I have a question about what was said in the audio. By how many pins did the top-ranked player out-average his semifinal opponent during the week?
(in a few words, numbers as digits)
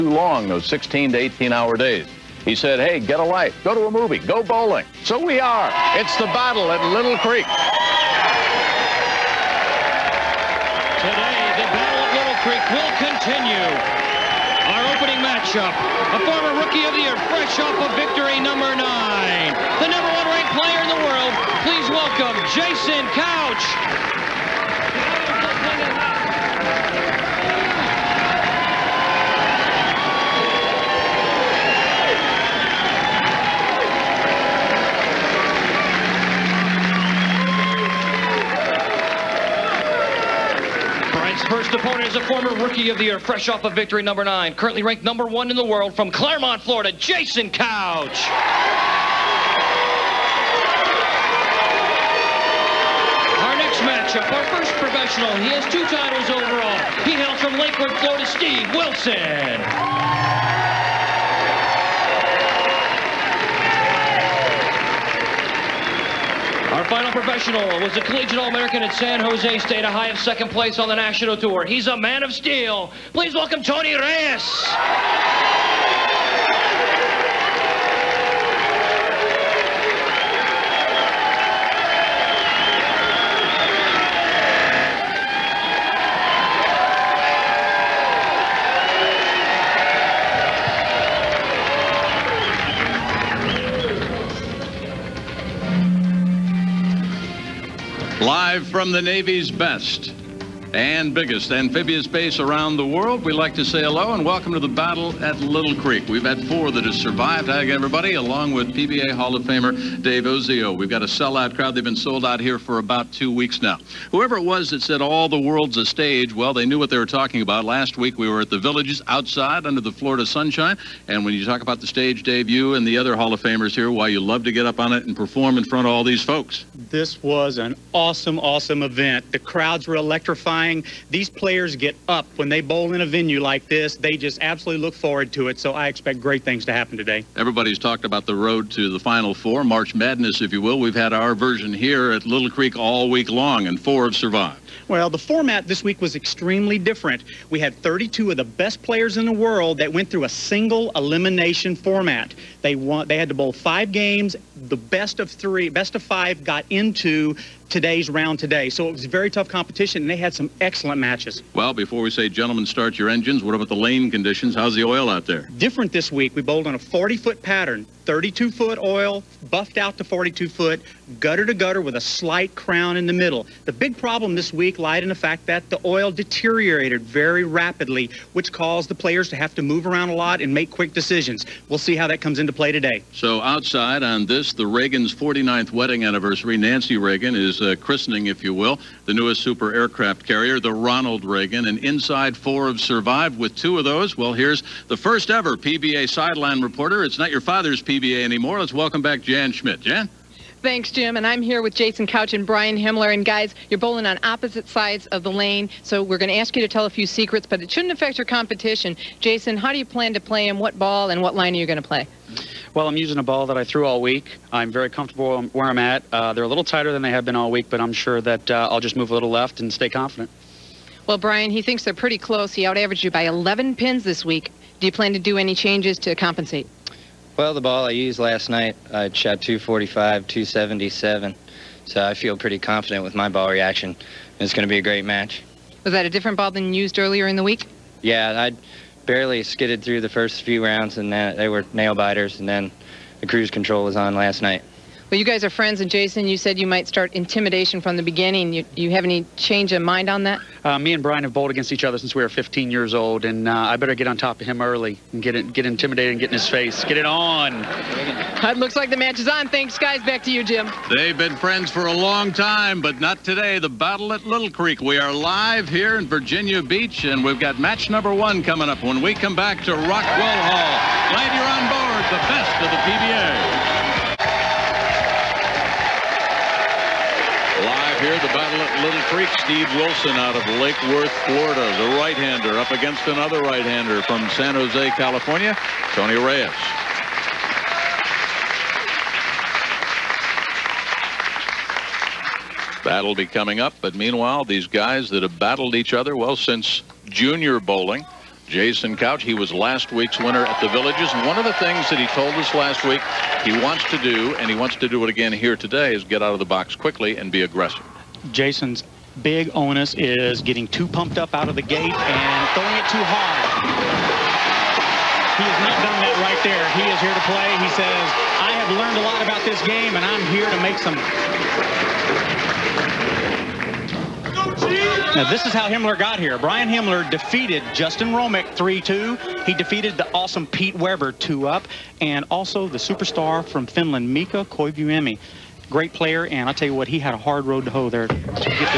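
11.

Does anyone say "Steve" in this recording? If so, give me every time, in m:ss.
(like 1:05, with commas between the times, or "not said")
0:58, 4:39.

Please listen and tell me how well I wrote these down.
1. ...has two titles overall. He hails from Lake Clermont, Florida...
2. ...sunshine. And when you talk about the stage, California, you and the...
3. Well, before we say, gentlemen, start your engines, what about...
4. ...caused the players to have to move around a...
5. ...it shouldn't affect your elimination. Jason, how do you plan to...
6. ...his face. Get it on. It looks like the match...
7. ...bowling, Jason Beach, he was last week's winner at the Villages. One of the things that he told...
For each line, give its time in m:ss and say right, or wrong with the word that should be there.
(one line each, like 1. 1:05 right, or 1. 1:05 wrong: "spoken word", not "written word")
1. 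0:55 wrong: "Worth", not "Clermont"
2. 2:00 wrong: "Dave", not "California"
3. 2:41 right
4. 2:58 right
5. 3:27 wrong: "competition", not "elimination"
6. 4:16 right
7. 4:57 wrong: "Couch", not "Beach".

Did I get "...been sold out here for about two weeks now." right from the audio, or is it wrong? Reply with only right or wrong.
right.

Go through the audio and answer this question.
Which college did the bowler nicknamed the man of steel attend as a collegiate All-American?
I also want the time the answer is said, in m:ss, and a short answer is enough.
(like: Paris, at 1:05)
San Jose State, at 1:08.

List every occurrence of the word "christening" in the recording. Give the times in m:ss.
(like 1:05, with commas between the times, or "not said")
3:07.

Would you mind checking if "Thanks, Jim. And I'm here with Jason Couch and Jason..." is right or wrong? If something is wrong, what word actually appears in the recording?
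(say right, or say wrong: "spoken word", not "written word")
wrong: "Brian", not "Jason".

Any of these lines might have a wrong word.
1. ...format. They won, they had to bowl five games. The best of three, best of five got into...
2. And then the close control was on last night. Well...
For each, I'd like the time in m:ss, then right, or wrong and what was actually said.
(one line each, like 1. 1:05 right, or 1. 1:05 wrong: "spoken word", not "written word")
1. 2:31 right
2. 4:02 wrong: "cruise", not "close".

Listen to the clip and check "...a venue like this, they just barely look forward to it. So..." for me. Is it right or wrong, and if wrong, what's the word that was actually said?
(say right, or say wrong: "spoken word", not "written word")
wrong: "absolutely", not "barely".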